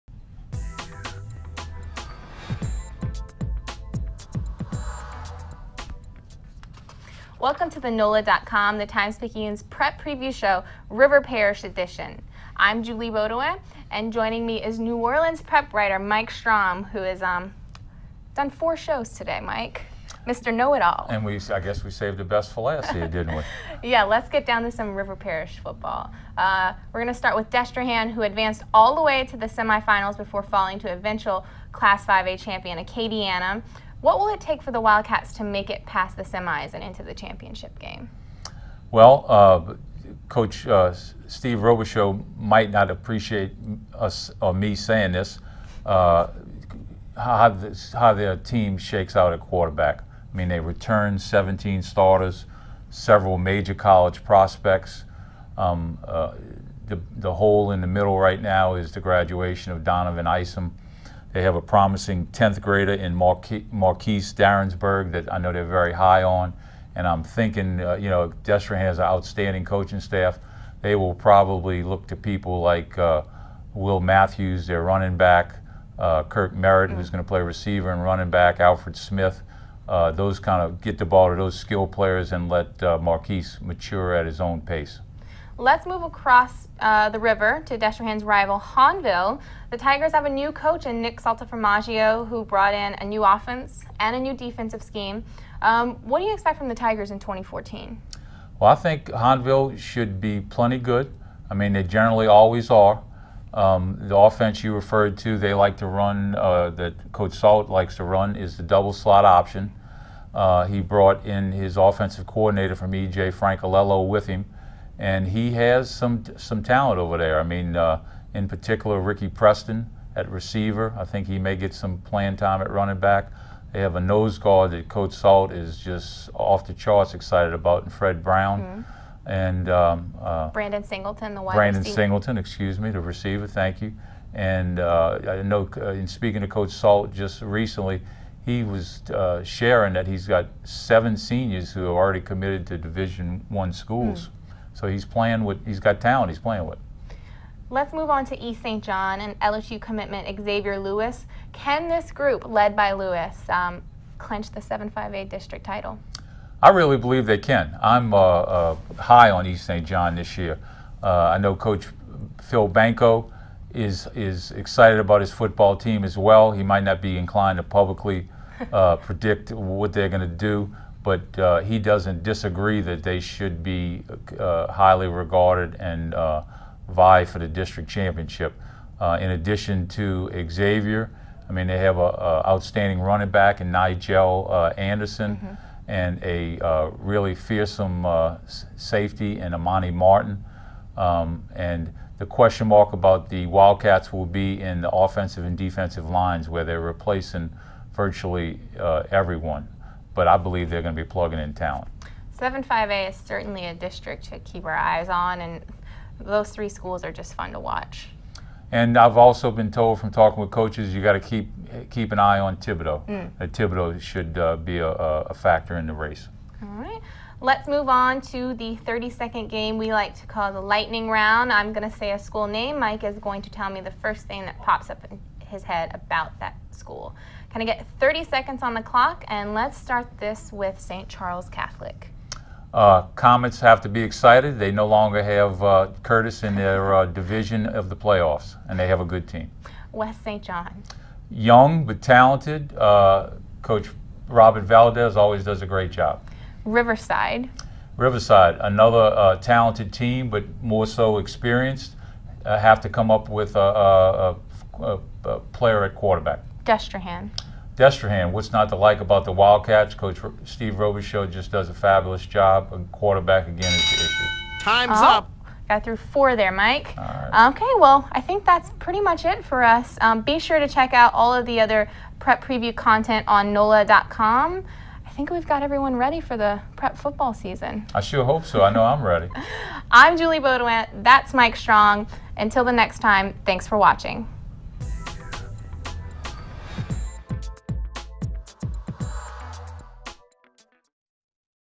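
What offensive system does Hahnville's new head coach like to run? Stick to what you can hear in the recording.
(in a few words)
double slot option.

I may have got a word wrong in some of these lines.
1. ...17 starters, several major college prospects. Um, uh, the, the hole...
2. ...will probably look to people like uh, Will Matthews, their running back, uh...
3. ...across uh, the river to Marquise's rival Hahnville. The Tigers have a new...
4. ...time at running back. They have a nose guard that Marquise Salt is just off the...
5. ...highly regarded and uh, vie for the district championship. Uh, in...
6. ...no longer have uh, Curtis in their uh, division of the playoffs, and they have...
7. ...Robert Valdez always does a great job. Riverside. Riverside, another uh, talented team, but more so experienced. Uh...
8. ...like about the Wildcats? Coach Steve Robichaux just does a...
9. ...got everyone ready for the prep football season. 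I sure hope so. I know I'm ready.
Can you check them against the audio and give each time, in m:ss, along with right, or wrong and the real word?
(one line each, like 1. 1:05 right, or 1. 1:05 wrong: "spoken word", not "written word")
1. 0:51 right
2. 1:10 right
3. 1:26 wrong: "Destrehan", not "Marquise"
4. 2:02 wrong: "Coach", not "Marquise"
5. 2:54 right
6. 3:54 right
7. 4:04 right
8. 4:18 right
9. 4:35 right.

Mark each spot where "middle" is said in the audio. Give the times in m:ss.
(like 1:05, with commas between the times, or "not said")
0:57.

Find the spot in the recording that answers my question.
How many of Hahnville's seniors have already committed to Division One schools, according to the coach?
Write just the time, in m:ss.
2:20.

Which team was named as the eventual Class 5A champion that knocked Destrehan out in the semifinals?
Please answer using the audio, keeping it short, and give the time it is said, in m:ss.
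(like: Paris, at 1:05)
Acadiana, at 0:32.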